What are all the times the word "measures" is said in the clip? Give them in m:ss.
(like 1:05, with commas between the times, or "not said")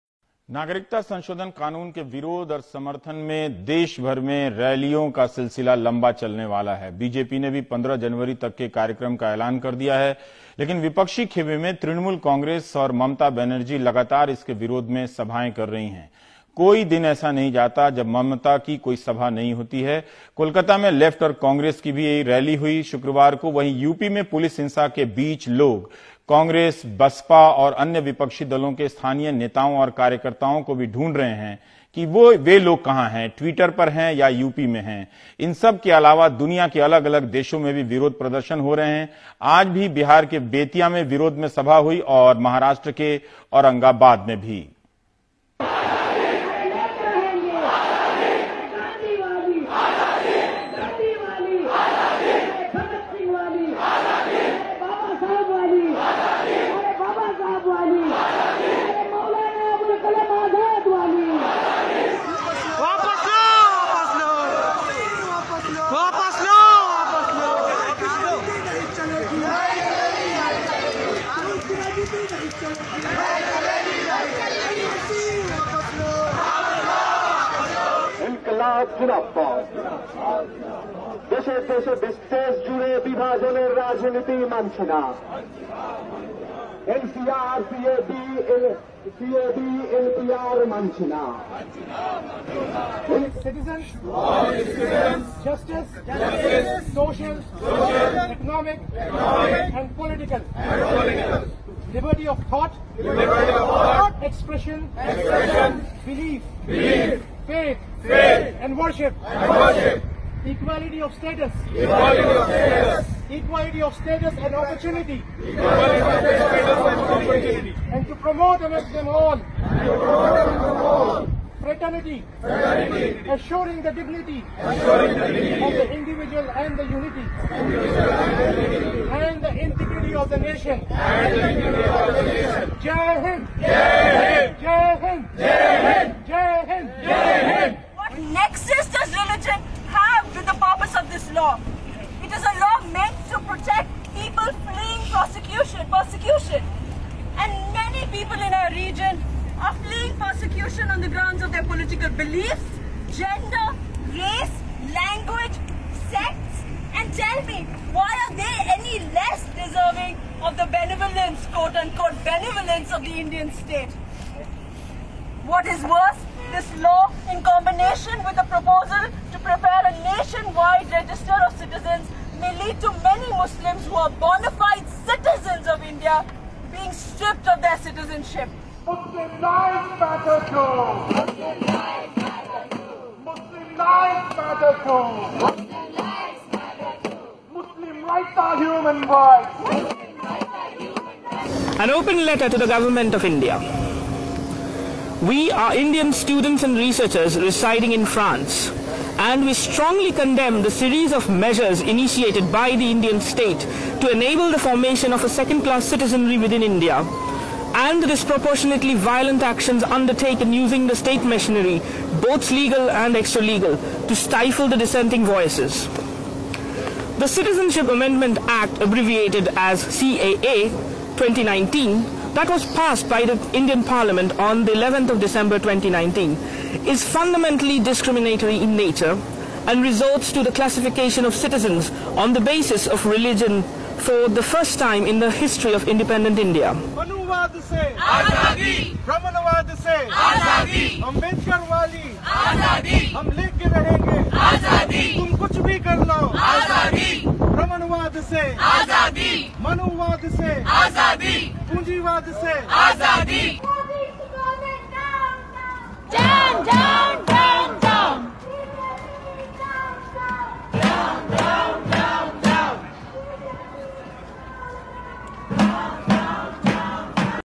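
3:21.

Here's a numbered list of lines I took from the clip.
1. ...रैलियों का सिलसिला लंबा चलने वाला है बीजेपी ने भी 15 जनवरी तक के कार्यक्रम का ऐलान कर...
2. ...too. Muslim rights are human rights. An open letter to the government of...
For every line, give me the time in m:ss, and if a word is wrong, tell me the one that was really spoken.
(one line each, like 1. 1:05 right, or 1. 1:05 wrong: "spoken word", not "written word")
1. 0:04 right
2. 3:02 right.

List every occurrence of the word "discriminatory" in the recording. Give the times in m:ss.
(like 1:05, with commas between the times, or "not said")
3:47.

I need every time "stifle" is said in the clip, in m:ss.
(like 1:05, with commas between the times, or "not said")
3:34.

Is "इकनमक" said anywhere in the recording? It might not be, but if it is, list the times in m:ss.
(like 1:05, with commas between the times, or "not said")
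1:38.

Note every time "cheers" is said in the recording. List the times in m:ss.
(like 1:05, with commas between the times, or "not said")
not said.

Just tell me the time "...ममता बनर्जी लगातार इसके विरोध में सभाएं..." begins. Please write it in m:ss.
0:13.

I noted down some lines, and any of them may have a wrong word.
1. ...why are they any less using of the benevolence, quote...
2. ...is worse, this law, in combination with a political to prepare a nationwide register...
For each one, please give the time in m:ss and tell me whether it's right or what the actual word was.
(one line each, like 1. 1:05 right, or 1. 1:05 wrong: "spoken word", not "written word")
1. 2:37 wrong: "deserving", not "using"
2. 2:45 wrong: "proposal", not "political".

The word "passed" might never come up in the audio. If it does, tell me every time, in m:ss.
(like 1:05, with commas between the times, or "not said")
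3:42.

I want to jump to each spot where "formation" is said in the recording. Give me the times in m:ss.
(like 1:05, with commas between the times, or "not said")
3:24.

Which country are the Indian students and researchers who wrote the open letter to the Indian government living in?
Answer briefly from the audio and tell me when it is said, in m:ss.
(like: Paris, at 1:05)
France, at 3:18.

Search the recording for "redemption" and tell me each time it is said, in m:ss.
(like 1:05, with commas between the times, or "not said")
not said.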